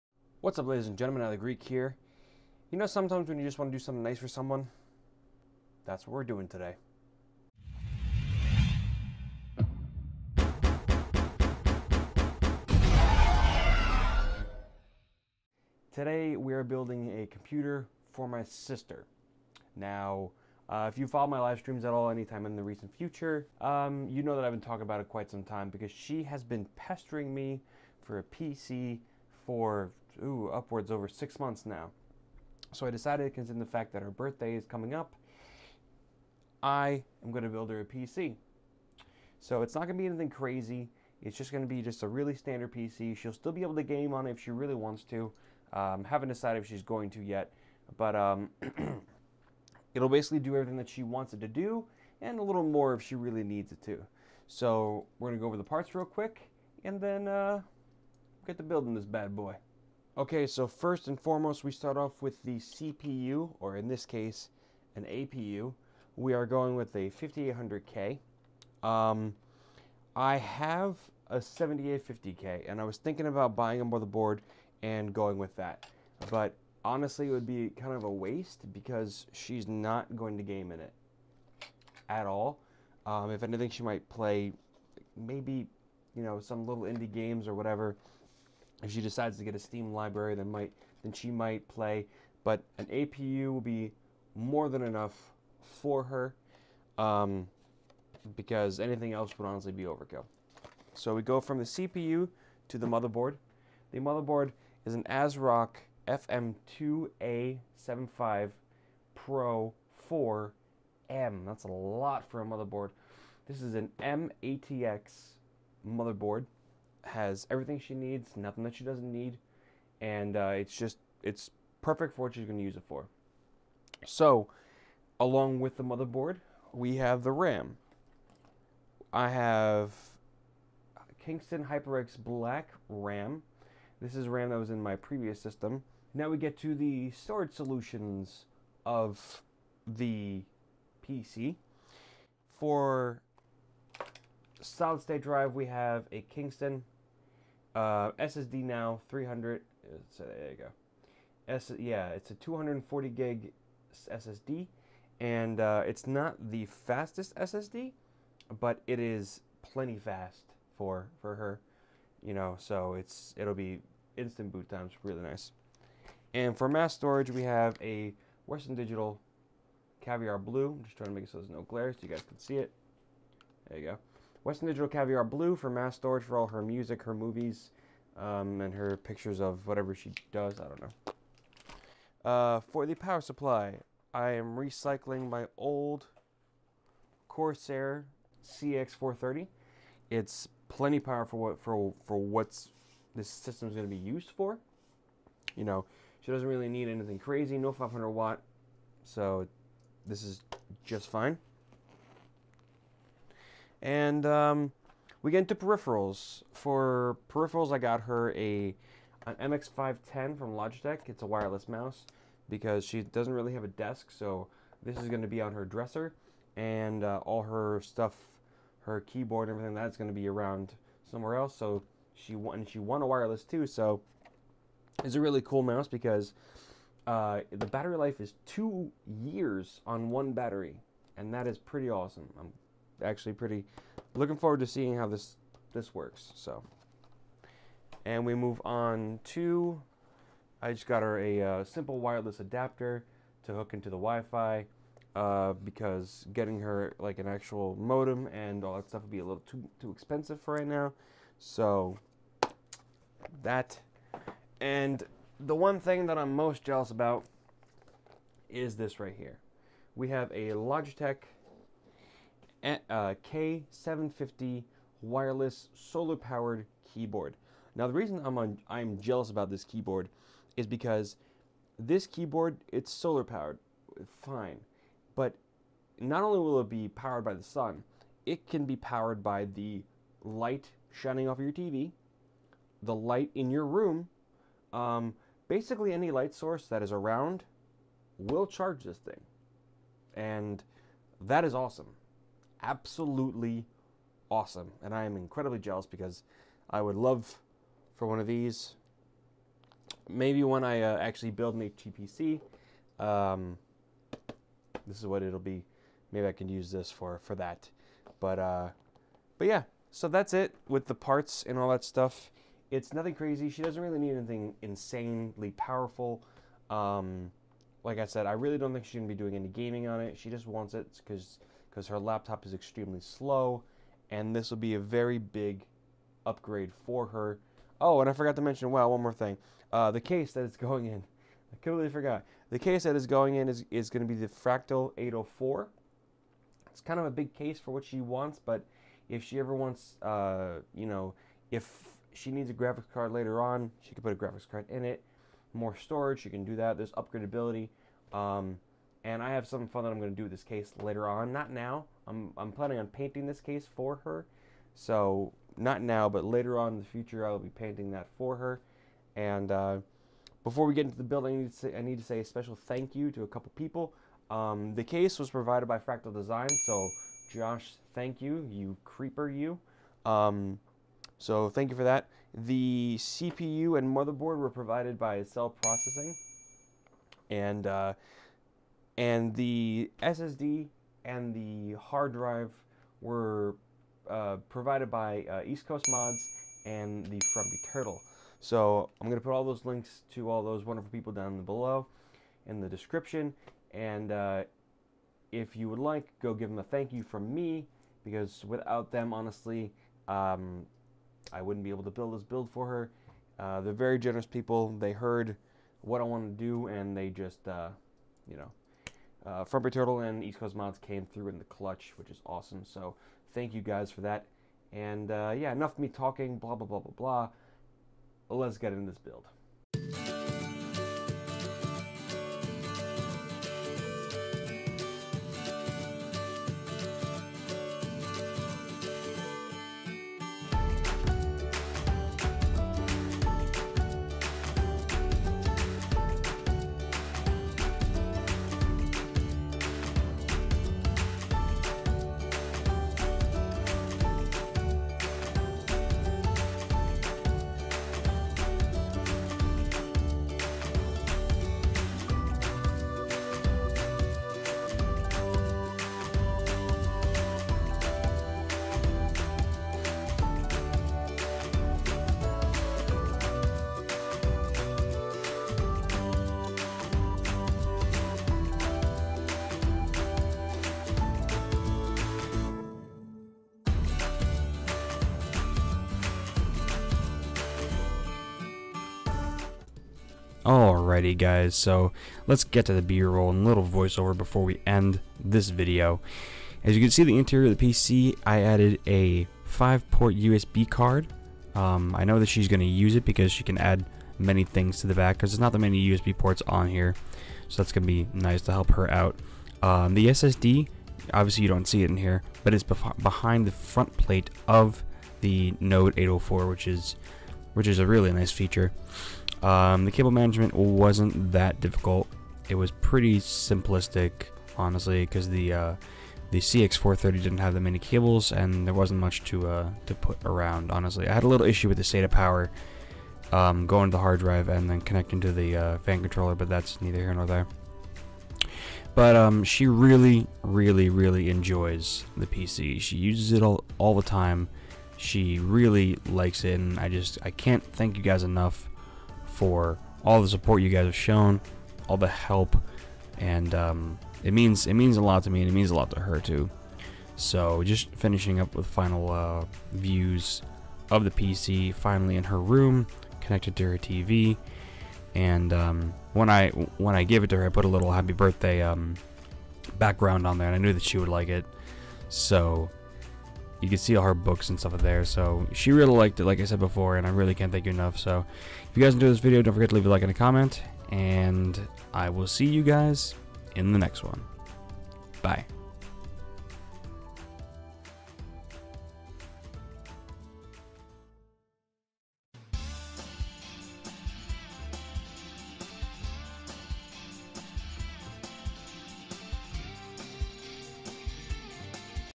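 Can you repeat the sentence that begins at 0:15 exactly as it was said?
Today, we are building a computer for my sister.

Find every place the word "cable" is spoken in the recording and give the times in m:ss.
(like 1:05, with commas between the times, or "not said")
8:29, 8:37.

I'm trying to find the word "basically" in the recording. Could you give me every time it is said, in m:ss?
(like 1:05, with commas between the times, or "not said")
0:50, 4:45.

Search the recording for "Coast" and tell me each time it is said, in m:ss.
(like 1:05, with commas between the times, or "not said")
6:25, 6:50.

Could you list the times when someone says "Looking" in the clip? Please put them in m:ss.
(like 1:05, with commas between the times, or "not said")
3:54.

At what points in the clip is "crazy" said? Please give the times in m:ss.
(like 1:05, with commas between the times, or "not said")
0:40, 3:17, 5:13.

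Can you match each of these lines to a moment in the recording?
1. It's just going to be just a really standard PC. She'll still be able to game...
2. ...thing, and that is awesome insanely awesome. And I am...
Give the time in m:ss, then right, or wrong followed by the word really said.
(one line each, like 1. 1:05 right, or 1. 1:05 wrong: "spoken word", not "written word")
1. 0:41 right
2. 4:48 wrong: "absolutely", not "insanely".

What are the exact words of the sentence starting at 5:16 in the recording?
Um, like I said, I really don't think she's going to be doing any gaming on it.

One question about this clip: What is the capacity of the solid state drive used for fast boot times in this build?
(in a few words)
240 gig.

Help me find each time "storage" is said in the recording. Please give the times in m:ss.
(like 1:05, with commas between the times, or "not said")
2:17, 2:46, 2:55, 5:45.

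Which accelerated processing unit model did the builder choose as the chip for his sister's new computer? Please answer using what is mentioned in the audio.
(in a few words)
5800K.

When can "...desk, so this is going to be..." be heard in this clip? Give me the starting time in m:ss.
3:33.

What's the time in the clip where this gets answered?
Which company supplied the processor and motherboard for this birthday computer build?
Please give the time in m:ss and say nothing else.
6:15.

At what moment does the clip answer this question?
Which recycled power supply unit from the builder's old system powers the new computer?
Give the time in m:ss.
3:07.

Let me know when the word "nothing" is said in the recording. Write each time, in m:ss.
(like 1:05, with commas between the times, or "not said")
1:58, 5:12.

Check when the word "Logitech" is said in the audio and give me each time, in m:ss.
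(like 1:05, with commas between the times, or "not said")
3:30, 4:20.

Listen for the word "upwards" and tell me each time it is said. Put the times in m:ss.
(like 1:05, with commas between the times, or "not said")
0:30.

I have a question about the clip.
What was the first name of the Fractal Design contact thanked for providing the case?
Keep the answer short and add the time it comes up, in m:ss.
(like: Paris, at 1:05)
Josh, at 6:07.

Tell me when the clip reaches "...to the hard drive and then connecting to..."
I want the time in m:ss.
8:43.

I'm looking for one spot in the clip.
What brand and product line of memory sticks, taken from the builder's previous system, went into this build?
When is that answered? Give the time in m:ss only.
2:11.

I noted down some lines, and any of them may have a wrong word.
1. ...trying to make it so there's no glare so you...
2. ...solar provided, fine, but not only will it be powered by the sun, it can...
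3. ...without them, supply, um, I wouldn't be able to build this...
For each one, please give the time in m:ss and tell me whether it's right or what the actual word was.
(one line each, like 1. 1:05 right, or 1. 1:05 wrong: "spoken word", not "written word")
1. 2:50 right
2. 4:32 wrong: "powered", not "provided"
3. 6:38 wrong: "honestly", not "supply".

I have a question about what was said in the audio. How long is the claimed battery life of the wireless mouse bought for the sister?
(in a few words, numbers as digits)
2 years.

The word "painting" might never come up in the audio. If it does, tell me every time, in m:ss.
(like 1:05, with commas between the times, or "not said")
5:52, 5:57.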